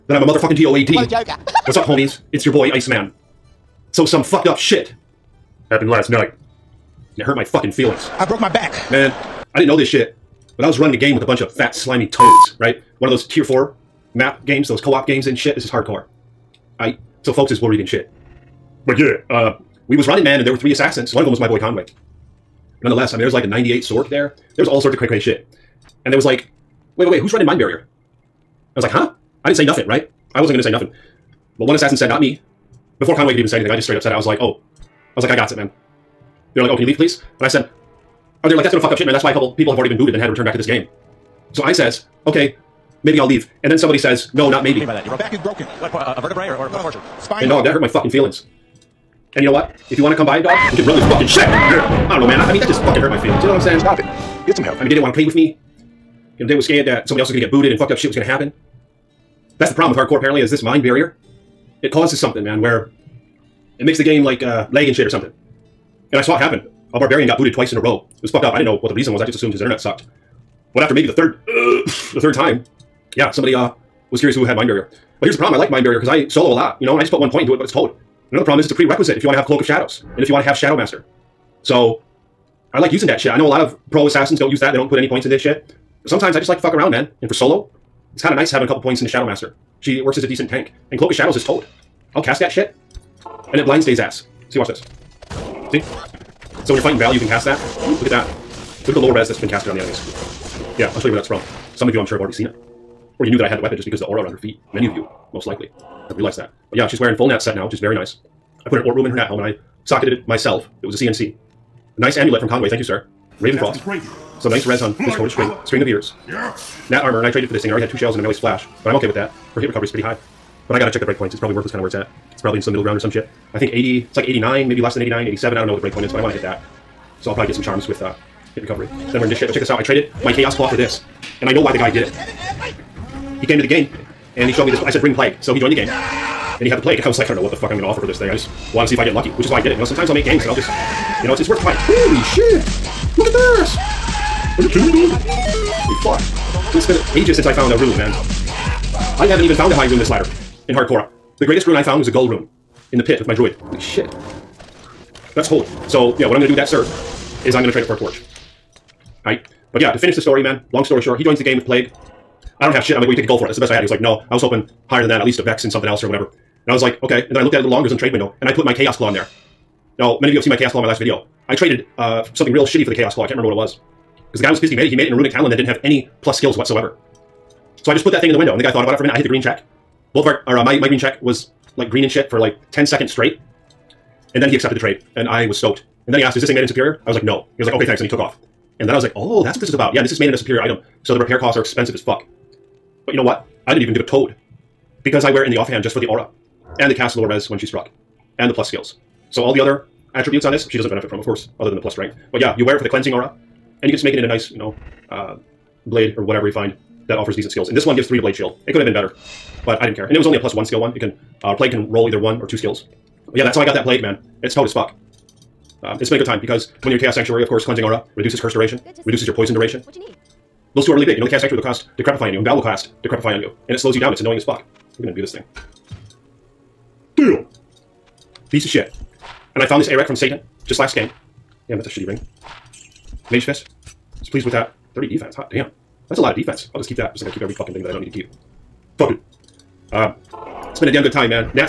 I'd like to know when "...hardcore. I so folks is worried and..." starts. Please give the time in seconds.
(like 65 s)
15 s.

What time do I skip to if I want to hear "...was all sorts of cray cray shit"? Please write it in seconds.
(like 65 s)
24 s.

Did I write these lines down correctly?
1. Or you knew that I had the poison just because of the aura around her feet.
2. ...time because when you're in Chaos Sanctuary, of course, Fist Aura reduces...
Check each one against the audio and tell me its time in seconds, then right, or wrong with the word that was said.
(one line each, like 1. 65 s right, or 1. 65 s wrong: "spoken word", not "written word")
1. 103 s wrong: "weapon", not "poison"
2. 216 s wrong: "Cleansing", not "Fist".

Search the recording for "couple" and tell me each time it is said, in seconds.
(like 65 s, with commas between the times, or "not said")
39 s, 88 s.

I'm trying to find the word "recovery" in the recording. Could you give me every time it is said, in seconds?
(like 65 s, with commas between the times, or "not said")
119 s, 128 s.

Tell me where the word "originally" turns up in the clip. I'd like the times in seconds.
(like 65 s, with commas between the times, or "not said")
not said.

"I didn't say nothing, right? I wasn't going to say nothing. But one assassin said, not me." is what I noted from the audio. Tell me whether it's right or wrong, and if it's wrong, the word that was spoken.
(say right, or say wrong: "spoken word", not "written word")
right.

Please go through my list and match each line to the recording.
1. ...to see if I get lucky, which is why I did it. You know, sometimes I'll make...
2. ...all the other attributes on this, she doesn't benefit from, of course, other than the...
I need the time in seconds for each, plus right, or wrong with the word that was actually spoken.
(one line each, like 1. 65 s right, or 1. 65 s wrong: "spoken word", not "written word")
1. 138 s right
2. 199 s right.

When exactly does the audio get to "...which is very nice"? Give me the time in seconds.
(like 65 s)
107 s.